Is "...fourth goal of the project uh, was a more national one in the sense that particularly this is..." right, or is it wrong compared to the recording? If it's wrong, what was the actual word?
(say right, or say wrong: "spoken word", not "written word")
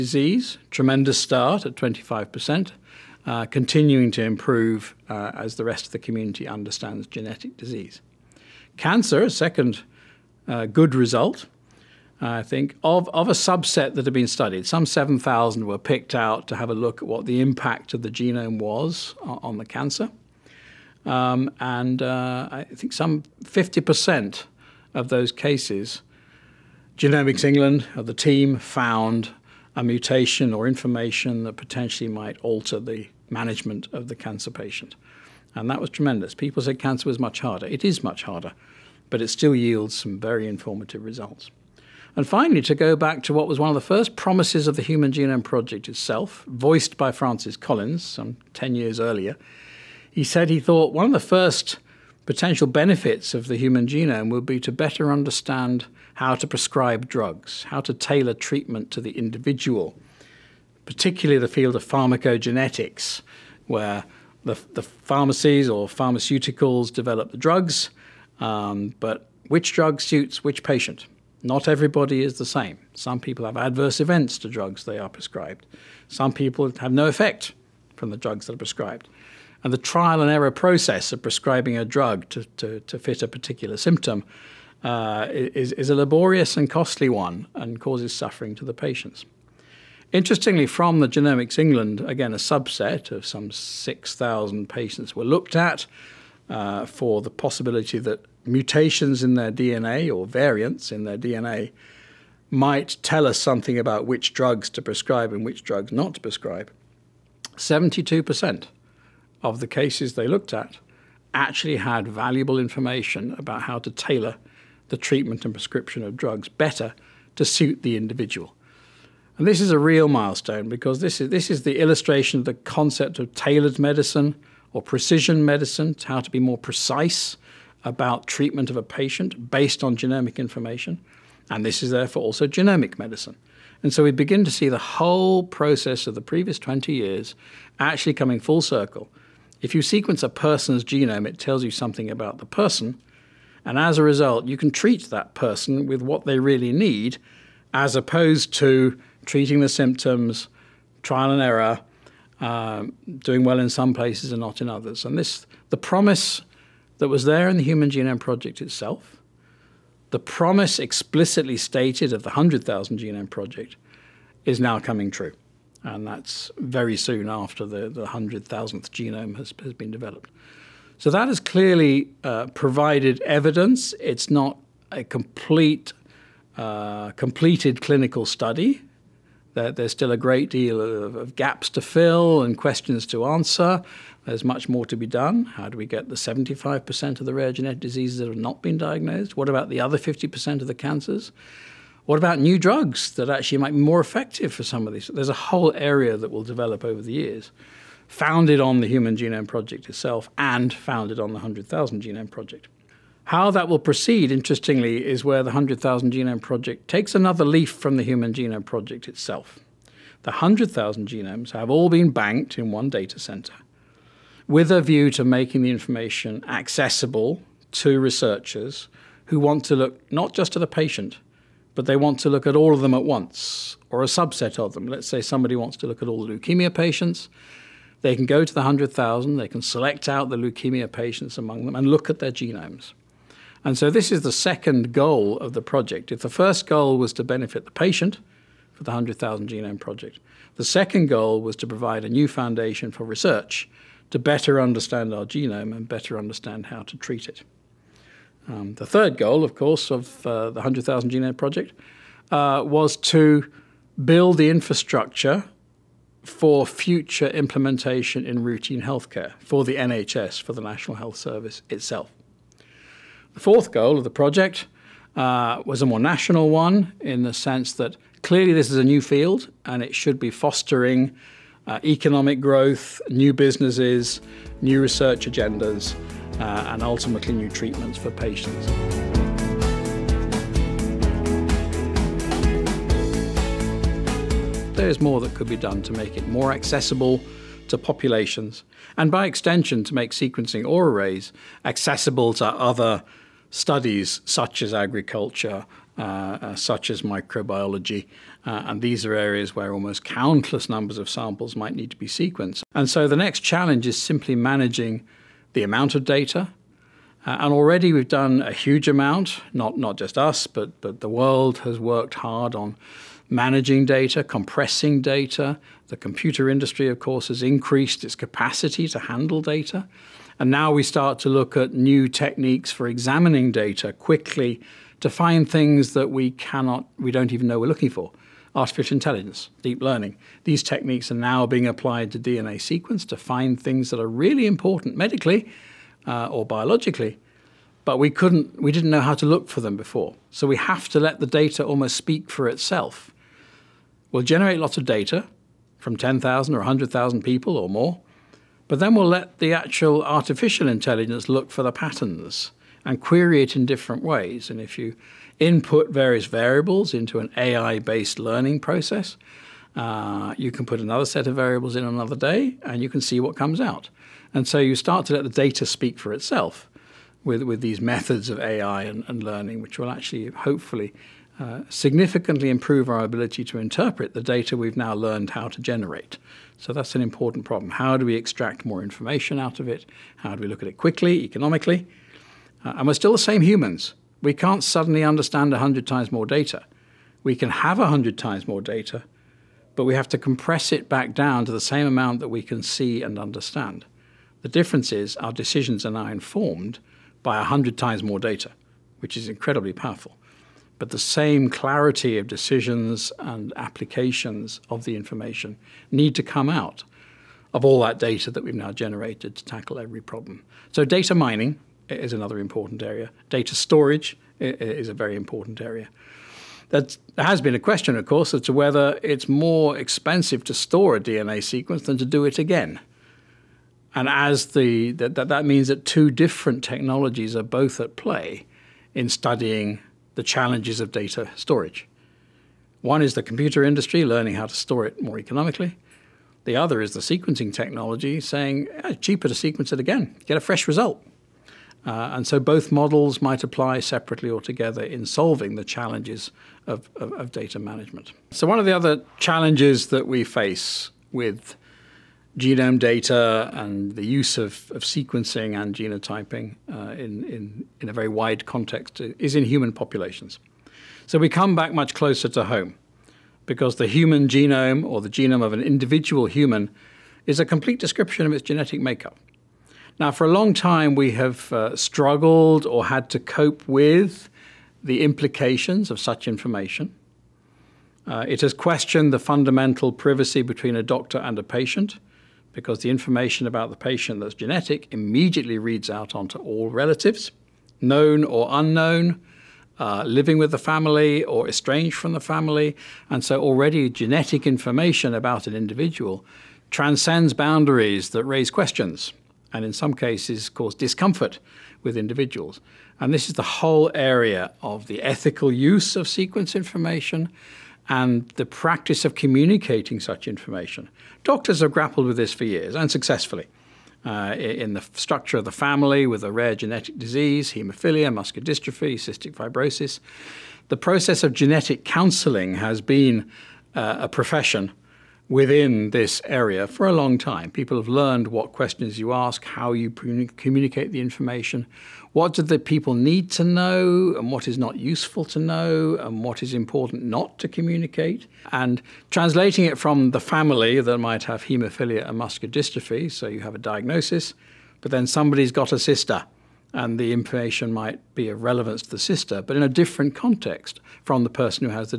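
wrong: "clearly", not "particularly".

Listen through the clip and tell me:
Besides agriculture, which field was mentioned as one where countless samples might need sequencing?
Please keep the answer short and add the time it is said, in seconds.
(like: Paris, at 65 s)
microbiology, at 297 s.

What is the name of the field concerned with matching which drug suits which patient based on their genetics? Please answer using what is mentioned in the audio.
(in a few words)
pharmacogenetics.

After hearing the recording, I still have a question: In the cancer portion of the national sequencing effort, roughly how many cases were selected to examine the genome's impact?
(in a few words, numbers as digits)
7,000.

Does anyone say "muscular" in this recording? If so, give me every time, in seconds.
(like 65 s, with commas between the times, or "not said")
518 s, 542 s.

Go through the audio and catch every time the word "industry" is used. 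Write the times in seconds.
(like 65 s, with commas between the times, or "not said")
316 s, 433 s.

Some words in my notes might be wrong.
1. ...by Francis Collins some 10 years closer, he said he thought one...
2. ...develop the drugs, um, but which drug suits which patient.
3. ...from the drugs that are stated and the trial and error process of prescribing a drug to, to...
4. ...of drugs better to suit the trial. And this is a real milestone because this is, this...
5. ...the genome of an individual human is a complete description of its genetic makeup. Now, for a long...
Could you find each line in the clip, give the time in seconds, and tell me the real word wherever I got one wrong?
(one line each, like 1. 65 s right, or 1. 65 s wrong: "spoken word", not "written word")
1. 46 s wrong: "earlier", not "closer"
2. 66 s right
3. 77 s wrong: "prescribed", not "stated"
4. 116 s wrong: "individual", not "trial"
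5. 464 s right.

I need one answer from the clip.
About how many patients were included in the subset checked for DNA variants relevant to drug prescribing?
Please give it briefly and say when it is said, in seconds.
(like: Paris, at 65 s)
6,000, at 93 s.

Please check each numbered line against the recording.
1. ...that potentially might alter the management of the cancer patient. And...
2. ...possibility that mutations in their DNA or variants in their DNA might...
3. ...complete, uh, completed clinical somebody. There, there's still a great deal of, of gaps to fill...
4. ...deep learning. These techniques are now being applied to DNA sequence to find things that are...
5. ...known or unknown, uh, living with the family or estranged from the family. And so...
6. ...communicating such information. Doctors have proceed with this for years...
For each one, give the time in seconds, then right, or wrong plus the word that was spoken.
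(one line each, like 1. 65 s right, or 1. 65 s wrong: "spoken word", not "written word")
1. 31 s right
2. 97 s right
3. 175 s wrong: "study", not "somebody"
4. 329 s right
5. 487 s right
6. 509 s wrong: "grappled", not "proceed".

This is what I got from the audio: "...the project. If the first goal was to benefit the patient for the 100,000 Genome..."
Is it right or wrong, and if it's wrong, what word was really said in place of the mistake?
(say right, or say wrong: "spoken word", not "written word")
right.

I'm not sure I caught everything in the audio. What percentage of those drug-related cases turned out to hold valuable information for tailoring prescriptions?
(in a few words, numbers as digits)
72%.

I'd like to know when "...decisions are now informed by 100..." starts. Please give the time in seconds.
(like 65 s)
395 s.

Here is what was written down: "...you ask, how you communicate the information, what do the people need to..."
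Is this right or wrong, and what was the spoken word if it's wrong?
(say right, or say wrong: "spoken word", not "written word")
right.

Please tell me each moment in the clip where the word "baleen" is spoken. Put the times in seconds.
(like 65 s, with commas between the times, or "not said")
not said.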